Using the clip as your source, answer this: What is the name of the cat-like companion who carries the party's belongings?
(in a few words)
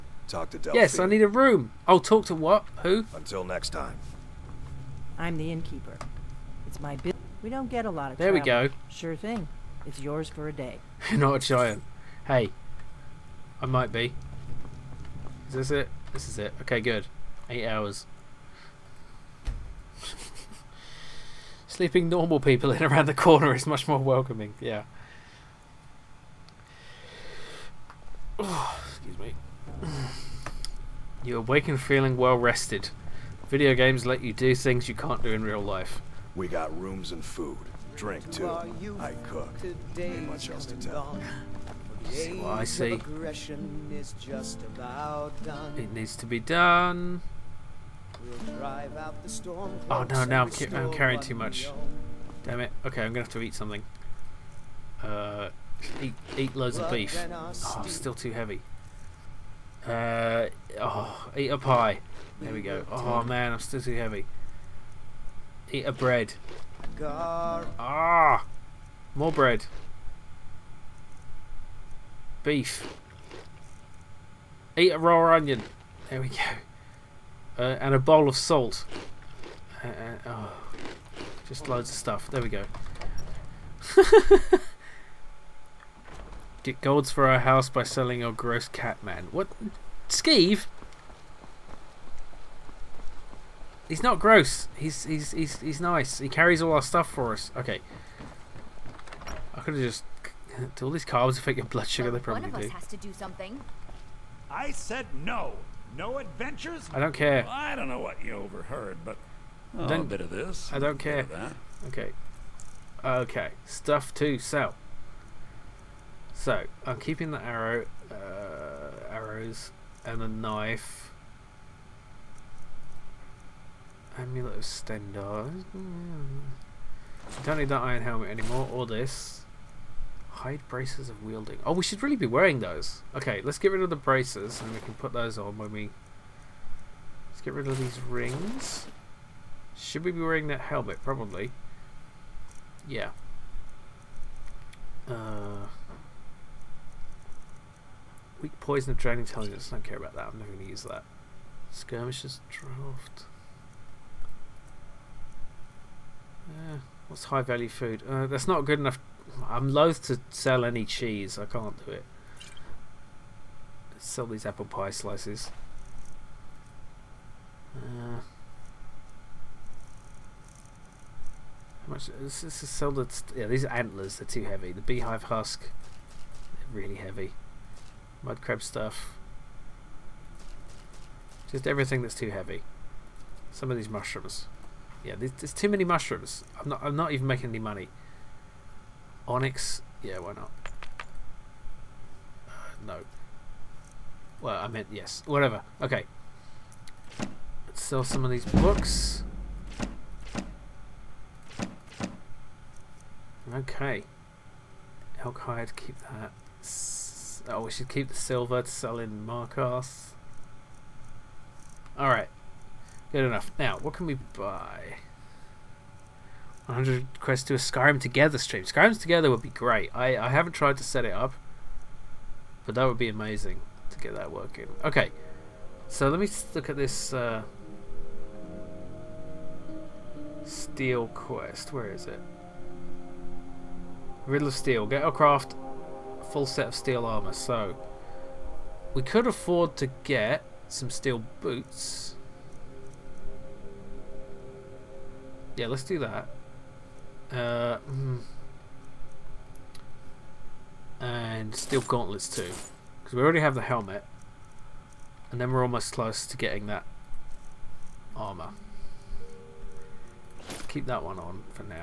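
Skeeve.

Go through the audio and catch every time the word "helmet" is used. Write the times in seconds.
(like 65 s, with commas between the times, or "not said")
128 s, 140 s, 253 s.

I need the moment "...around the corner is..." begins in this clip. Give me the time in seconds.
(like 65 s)
22 s.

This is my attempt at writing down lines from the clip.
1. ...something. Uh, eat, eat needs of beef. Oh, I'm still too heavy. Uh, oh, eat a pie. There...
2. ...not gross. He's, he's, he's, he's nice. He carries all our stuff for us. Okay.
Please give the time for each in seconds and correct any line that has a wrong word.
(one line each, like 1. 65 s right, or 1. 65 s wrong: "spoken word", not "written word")
1. 53 s wrong: "loads", not "needs"
2. 94 s right.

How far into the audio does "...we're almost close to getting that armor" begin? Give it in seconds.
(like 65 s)
255 s.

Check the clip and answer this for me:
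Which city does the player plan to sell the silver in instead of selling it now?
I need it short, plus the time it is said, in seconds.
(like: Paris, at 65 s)
Markarth, at 209 s.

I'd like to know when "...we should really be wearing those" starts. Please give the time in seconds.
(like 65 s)
131 s.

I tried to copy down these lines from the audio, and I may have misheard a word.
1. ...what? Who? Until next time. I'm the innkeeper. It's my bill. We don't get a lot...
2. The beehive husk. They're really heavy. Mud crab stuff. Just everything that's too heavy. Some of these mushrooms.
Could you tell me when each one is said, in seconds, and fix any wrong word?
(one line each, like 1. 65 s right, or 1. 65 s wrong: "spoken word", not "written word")
1. 2 s right
2. 174 s right.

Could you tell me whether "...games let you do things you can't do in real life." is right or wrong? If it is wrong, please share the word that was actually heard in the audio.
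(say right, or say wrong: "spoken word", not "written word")
right.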